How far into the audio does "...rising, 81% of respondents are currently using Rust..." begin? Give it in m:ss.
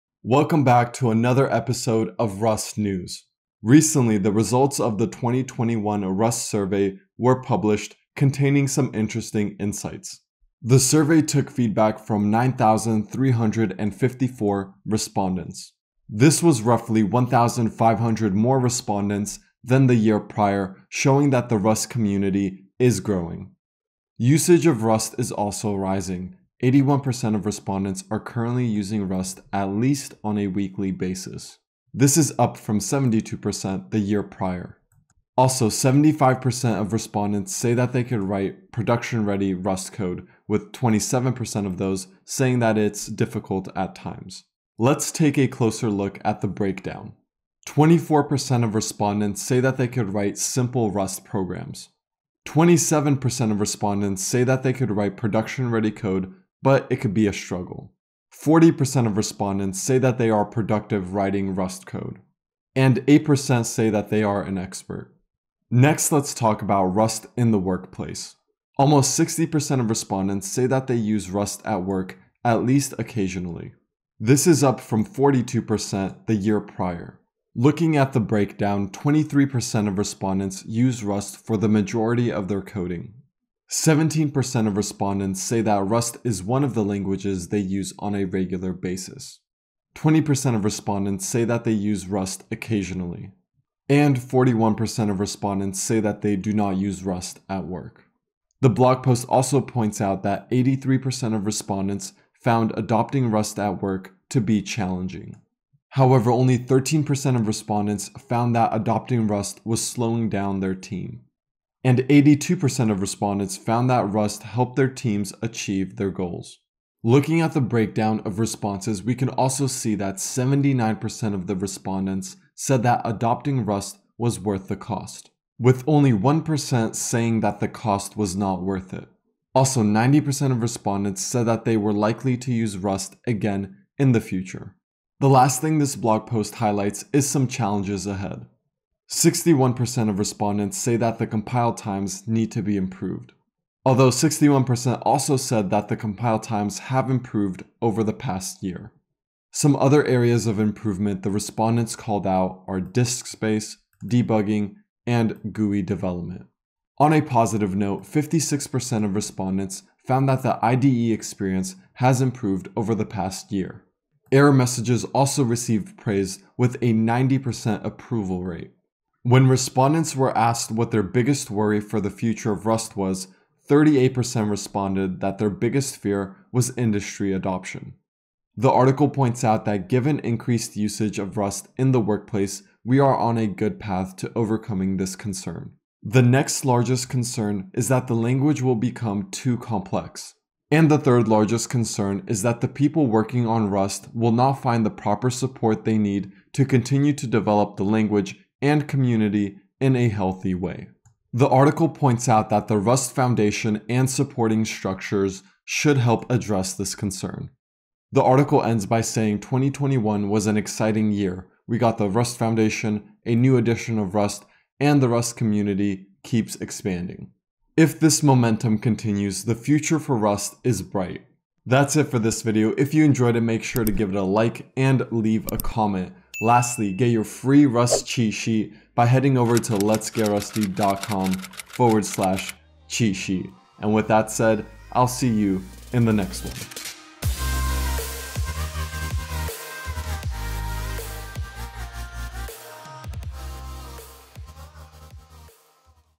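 0:25.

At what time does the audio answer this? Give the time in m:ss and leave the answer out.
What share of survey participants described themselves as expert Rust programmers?
1:03.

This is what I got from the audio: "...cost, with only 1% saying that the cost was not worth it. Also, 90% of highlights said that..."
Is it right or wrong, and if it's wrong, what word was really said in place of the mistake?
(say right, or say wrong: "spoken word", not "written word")
wrong: "respondents", not "highlights".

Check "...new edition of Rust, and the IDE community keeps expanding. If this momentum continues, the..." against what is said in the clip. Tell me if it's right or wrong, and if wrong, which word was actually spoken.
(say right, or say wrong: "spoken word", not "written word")
wrong: "Rust", not "IDE".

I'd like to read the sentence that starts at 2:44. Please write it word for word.
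Error messages also received praise with a 90% approval rate.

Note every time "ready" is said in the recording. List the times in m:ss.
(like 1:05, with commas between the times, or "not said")
0:39, 0:55.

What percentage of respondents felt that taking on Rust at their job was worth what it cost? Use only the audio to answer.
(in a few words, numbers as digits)
79%.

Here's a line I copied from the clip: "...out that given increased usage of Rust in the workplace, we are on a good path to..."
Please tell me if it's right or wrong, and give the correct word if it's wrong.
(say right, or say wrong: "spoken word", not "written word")
right.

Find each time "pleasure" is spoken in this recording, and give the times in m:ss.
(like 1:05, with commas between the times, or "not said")
not said.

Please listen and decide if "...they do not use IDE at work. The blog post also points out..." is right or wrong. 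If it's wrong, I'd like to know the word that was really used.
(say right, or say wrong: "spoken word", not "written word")
wrong: "Rust", not "IDE".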